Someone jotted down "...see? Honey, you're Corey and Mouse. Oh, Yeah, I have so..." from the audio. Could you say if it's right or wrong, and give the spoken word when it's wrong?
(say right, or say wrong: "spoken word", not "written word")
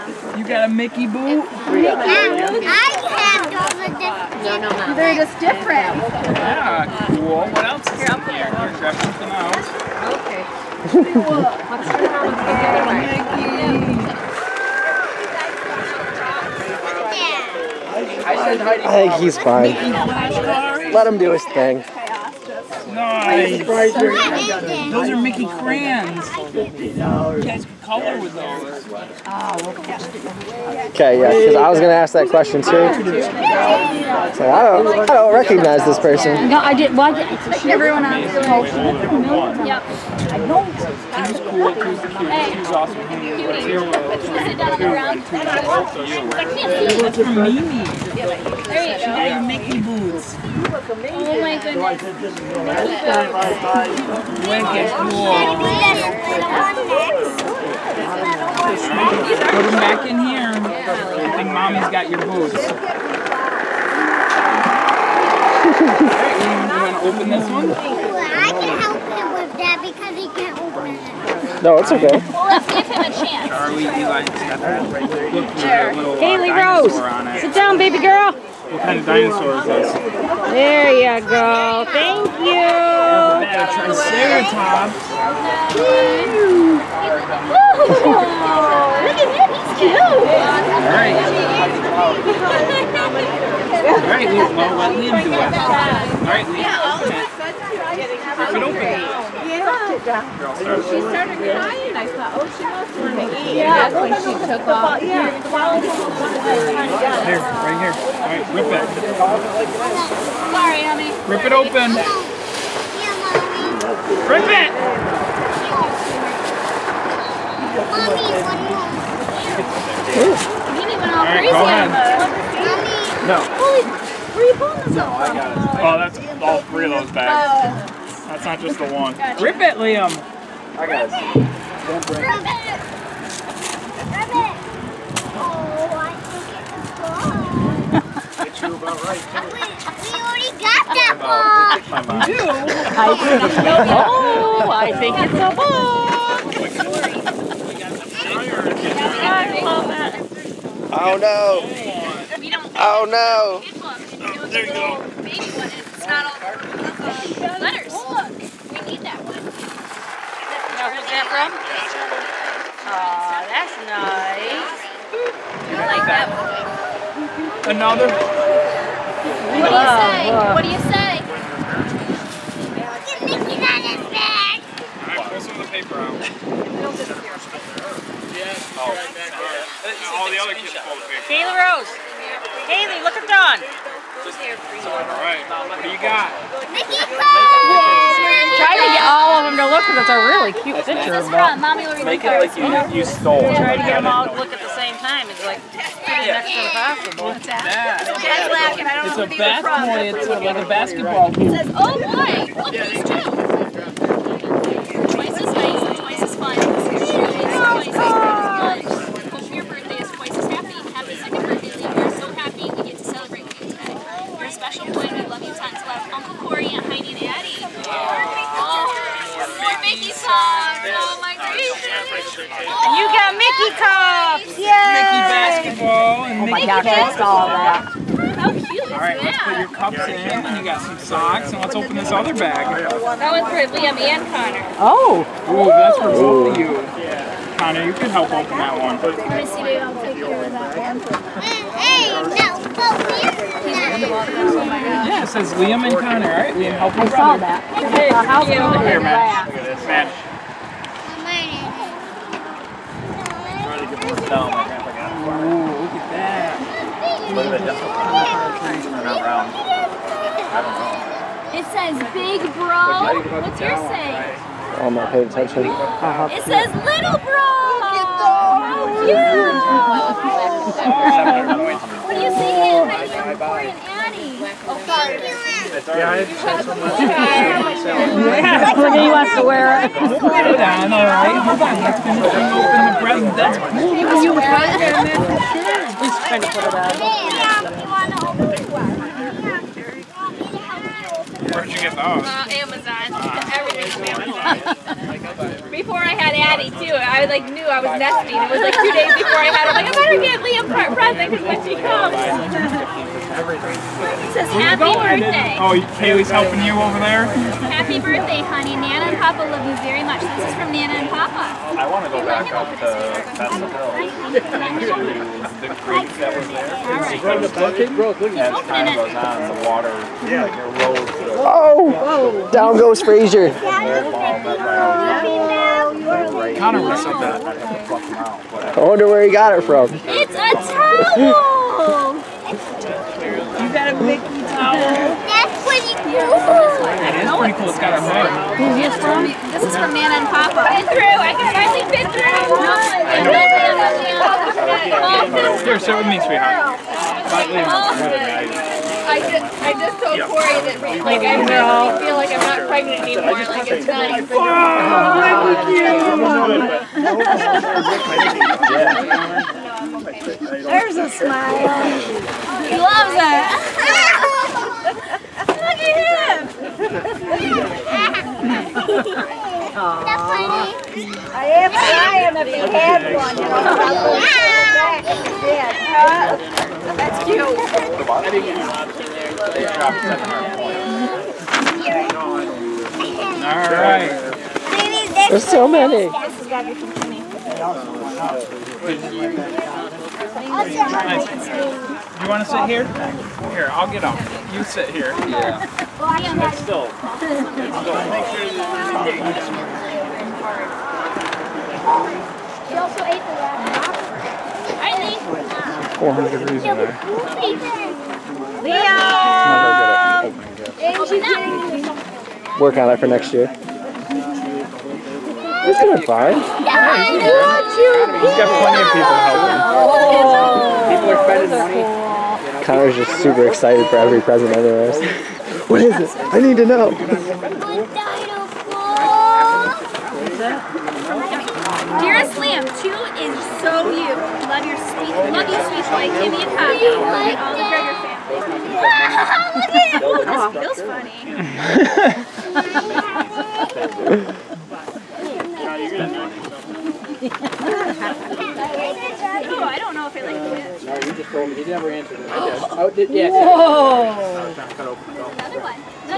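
wrong: "Annie", not "Mouse".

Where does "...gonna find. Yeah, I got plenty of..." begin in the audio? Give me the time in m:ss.
6:55.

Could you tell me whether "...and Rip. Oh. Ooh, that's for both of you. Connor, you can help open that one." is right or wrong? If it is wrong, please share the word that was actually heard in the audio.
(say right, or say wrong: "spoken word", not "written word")
wrong: "Connor", not "Rip".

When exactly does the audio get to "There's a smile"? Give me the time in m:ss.
6:00.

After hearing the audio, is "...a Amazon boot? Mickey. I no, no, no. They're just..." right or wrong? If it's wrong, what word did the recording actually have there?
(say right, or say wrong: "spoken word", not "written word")
wrong: "Mickey", not "Amazon".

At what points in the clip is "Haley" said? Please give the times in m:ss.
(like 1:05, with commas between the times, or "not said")
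1:16, 3:02.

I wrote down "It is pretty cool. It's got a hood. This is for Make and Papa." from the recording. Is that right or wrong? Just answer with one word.
wrong.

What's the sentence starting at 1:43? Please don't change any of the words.
Yeah, that's when she took off.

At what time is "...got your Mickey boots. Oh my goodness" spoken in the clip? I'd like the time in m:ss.
0:49.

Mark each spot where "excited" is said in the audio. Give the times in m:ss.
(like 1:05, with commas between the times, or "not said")
7:03.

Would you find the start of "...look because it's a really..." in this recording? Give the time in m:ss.
3:09.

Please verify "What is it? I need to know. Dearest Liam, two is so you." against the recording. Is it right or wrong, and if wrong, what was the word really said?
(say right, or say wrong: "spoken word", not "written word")
right.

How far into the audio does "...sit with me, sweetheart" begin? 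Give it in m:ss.
5:45.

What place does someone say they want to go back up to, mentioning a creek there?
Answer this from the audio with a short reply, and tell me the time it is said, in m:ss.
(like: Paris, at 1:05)
Bethel Hills, at 5:12.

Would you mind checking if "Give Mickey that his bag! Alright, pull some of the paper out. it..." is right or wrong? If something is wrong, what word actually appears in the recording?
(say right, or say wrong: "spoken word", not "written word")
right.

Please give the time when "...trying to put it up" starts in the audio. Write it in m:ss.
4:46.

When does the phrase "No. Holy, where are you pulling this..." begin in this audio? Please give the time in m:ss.
2:03.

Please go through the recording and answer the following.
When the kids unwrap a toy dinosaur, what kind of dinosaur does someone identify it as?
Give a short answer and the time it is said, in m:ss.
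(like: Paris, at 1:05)
Triceratops, at 1:23.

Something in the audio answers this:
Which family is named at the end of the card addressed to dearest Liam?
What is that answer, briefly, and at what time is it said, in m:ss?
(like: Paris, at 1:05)
The Gregor family, at 7:20.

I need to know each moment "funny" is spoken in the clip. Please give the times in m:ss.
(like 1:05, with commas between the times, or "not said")
7:27.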